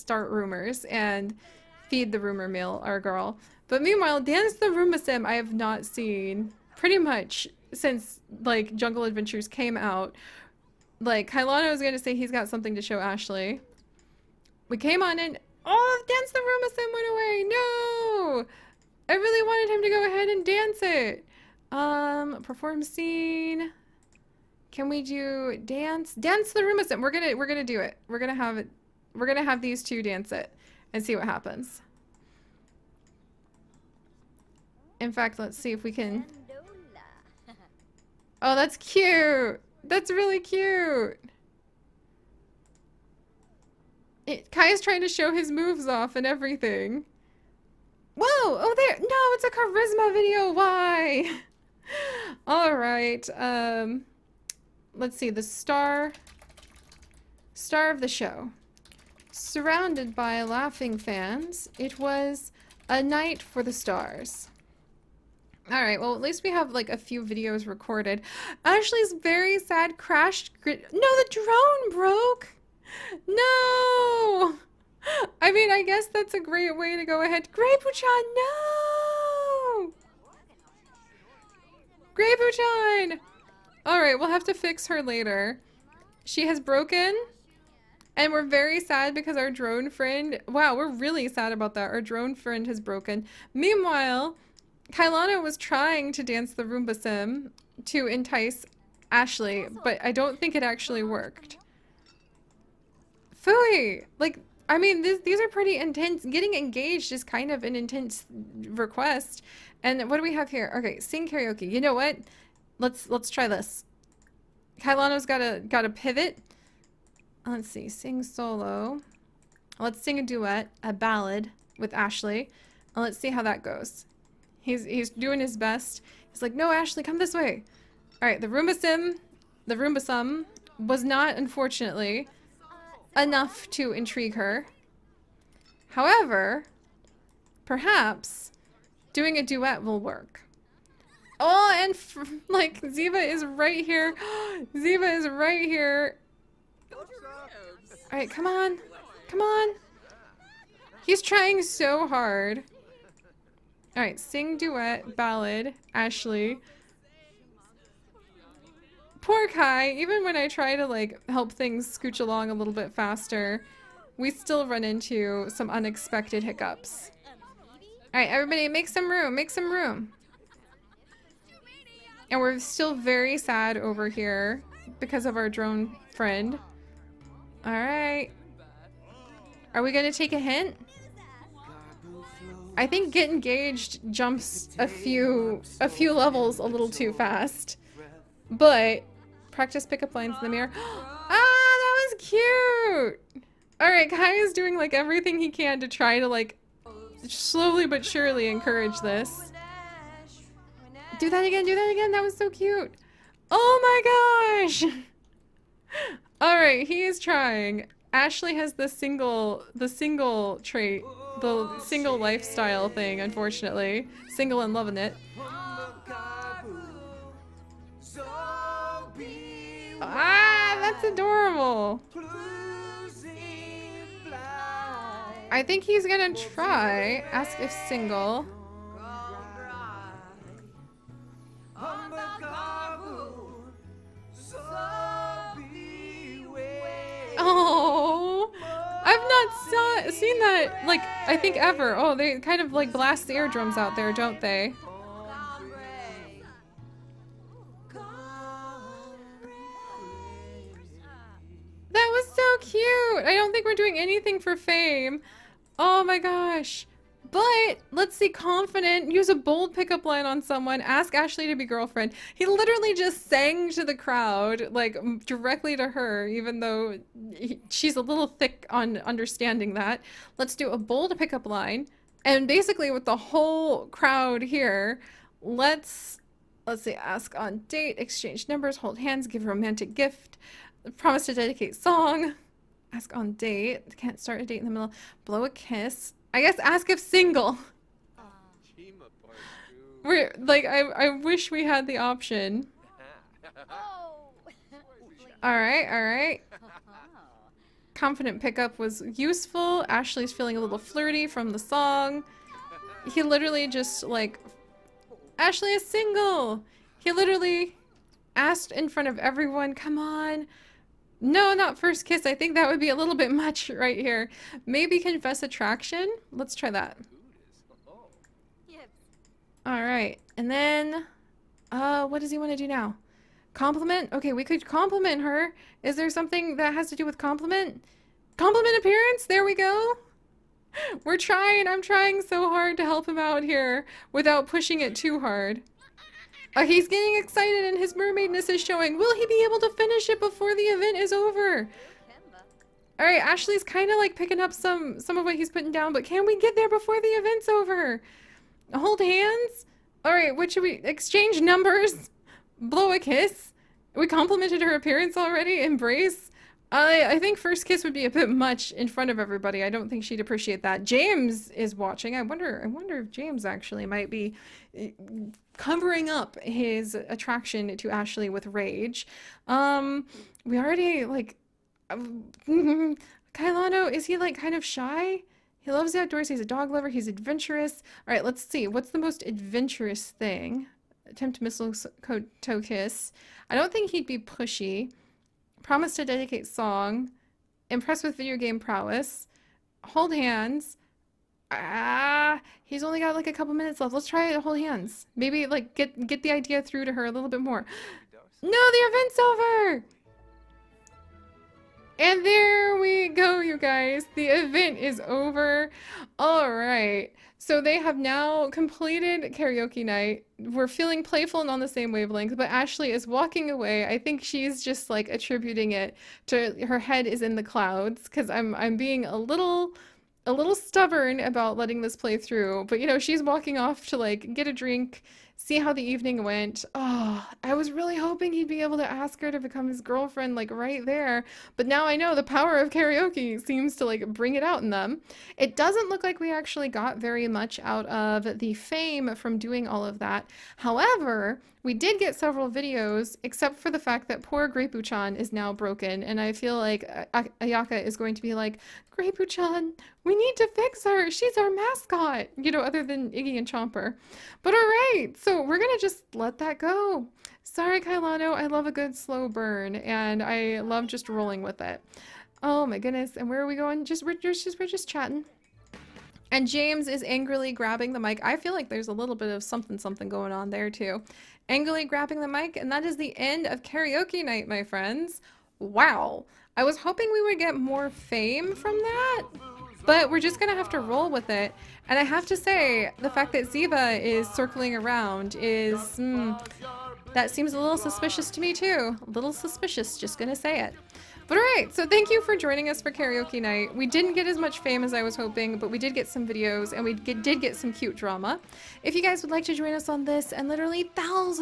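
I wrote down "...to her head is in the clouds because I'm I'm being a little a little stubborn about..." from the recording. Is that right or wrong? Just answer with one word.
right.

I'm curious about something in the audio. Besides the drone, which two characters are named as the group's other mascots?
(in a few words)
Iggy and Chomper.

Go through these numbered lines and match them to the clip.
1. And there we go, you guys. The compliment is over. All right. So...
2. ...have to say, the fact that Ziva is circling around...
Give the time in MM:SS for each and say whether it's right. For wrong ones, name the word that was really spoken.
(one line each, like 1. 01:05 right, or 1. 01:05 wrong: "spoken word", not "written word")
1. 06:41 wrong: "event", not "compliment"
2. 08:02 right.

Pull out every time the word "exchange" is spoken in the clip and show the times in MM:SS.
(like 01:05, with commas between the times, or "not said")
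04:37, 05:50.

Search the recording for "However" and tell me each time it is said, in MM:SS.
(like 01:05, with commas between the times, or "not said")
02:15, 07:20.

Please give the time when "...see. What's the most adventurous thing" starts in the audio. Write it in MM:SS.
06:18.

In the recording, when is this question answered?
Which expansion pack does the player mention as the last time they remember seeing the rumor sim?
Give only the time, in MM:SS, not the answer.
00:08.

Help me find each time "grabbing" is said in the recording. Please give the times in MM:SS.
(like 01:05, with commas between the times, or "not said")
07:47, 07:51.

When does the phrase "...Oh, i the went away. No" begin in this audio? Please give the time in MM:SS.
00:15.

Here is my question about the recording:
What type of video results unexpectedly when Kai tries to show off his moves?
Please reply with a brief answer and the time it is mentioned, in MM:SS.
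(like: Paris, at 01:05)
charisma video, at 00:49.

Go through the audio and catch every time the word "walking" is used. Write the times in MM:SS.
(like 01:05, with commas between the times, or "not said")
06:53, 07:03.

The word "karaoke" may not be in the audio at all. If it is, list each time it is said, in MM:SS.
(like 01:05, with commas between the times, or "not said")
01:51, 06:49, 07:12, 07:53, 08:12.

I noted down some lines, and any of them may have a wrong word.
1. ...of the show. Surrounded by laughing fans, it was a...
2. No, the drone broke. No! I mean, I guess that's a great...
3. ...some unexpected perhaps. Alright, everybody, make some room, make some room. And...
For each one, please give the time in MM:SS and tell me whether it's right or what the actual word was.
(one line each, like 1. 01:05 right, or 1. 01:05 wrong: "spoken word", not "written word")
1. 00:57 right
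2. 01:10 right
3. 02:45 wrong: "hiccups", not "perhaps".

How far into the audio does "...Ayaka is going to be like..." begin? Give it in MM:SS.
07:27.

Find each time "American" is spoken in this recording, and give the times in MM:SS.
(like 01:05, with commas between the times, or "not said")
not said.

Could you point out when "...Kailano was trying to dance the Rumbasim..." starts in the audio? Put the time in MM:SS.
01:34.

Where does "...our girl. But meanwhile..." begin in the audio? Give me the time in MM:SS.
00:02.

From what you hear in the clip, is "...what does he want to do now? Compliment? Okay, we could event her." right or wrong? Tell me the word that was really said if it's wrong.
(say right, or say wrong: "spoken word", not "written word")
wrong: "compliment", not "event".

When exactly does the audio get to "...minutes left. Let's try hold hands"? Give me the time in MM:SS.
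06:33.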